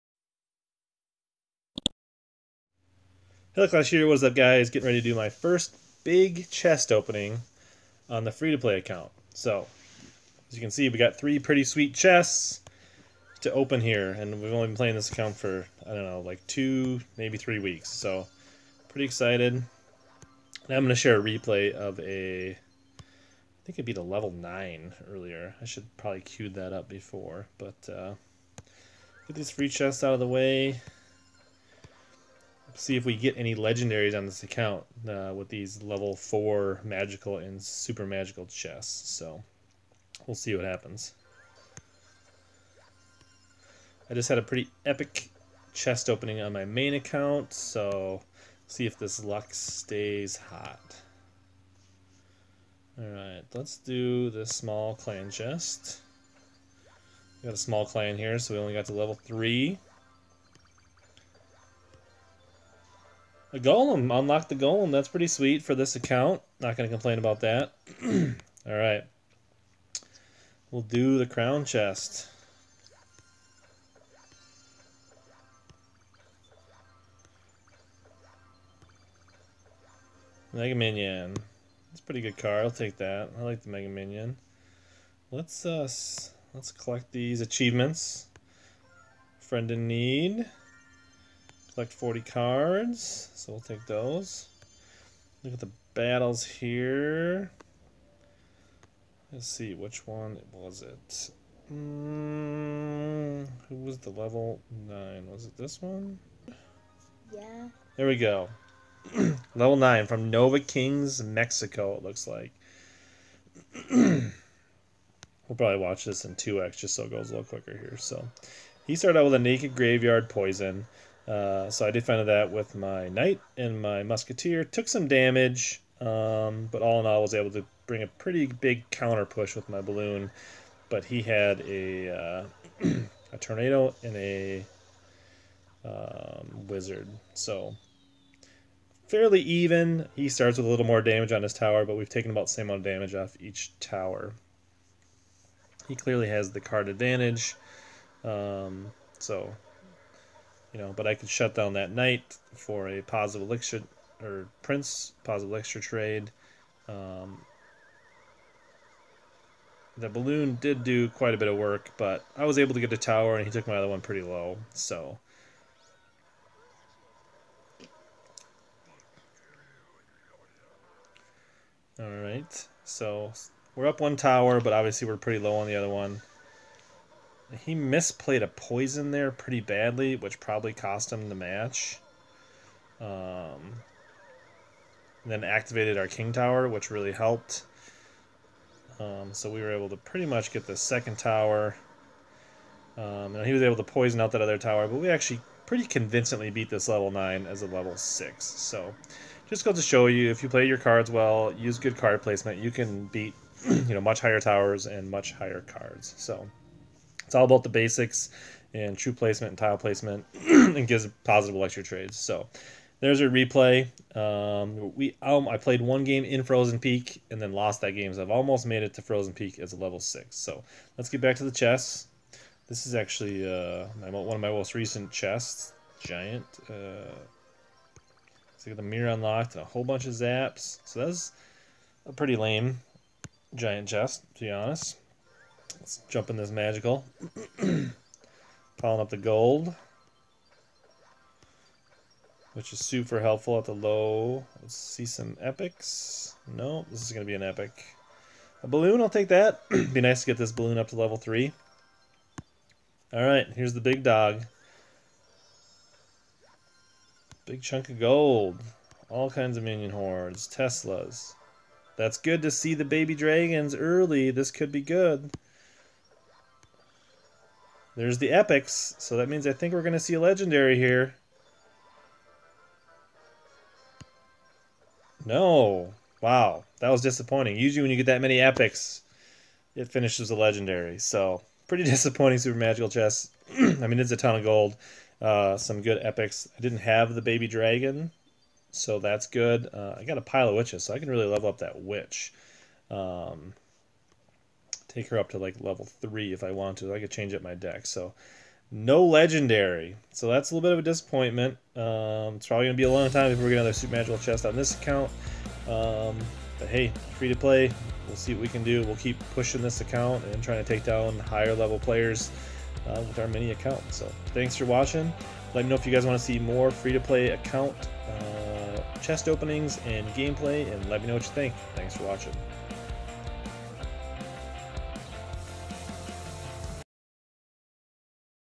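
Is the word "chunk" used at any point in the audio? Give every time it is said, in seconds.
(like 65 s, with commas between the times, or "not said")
257 s.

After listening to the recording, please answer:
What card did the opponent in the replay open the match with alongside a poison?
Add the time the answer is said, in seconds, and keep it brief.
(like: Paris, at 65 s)
Graveyard, at 119 s.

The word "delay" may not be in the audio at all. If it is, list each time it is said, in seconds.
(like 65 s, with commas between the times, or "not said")
not said.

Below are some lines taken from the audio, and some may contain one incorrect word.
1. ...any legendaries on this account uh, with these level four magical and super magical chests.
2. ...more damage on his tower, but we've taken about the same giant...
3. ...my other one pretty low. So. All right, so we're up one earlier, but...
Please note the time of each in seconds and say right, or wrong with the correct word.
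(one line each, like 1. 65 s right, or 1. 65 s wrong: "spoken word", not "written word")
1. 33 s right
2. 140 s wrong: "amount", not "giant"
3. 163 s wrong: "tower", not "earlier".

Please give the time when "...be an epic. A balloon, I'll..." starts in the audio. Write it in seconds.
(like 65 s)
247 s.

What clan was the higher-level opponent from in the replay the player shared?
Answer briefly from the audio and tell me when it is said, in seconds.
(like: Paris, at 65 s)
Nova Kings, at 110 s.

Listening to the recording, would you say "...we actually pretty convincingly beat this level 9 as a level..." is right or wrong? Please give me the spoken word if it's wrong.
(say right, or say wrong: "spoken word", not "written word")
right.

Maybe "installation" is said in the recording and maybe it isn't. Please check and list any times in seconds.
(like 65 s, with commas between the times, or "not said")
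not said.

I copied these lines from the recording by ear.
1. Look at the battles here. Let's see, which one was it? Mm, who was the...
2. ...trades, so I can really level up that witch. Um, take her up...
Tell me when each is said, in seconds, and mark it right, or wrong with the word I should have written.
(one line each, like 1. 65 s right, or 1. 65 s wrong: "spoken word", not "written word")
1. 95 s right
2. 290 s wrong: "witches", not "trades".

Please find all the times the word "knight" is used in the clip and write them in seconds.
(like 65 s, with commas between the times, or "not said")
123 s, 151 s.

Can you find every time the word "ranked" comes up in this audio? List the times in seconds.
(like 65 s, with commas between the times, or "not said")
not said.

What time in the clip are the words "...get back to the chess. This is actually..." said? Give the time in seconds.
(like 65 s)
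221 s.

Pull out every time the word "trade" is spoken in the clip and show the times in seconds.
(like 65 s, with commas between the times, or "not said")
155 s, 211 s.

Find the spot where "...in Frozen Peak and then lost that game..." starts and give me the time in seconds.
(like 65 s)
216 s.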